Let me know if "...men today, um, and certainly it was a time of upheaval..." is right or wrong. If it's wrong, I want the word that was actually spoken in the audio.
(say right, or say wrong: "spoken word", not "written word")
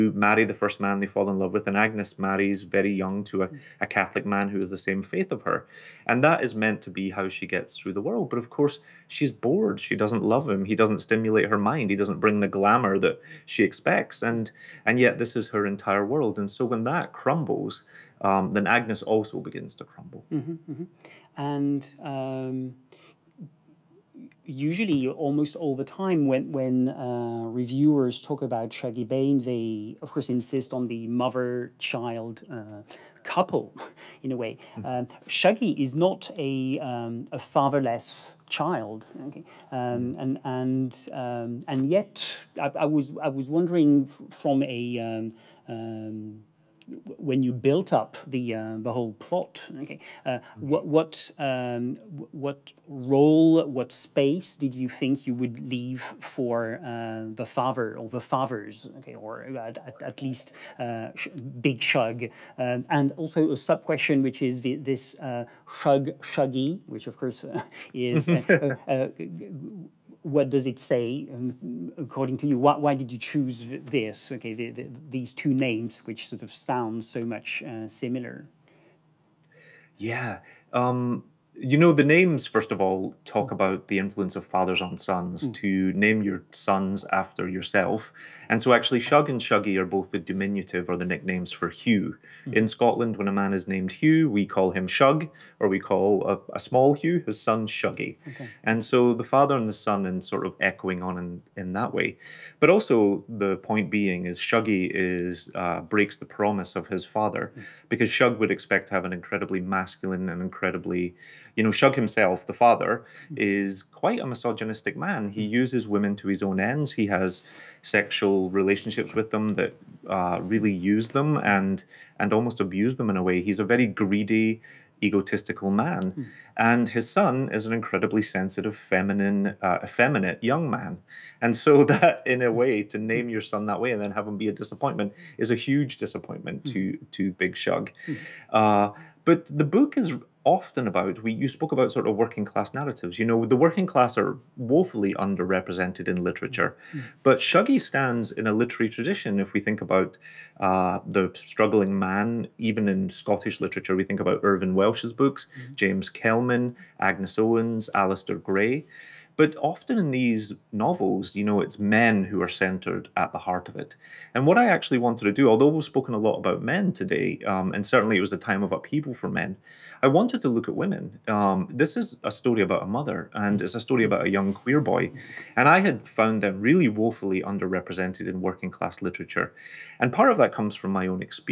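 right.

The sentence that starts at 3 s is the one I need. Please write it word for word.
a Catholic man who is the same faith of her.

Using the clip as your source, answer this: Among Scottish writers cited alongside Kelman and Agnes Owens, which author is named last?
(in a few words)
Alasdair Gray.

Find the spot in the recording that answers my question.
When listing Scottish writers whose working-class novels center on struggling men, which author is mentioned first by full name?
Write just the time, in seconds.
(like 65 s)
154 s.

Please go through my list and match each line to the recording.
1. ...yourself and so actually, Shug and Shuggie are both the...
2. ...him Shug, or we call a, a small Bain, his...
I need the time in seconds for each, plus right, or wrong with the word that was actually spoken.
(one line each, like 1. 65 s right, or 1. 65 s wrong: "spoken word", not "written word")
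1. 87 s right
2. 94 s wrong: "Hugh", not "Bain".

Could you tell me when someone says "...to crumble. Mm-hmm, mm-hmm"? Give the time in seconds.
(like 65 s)
19 s.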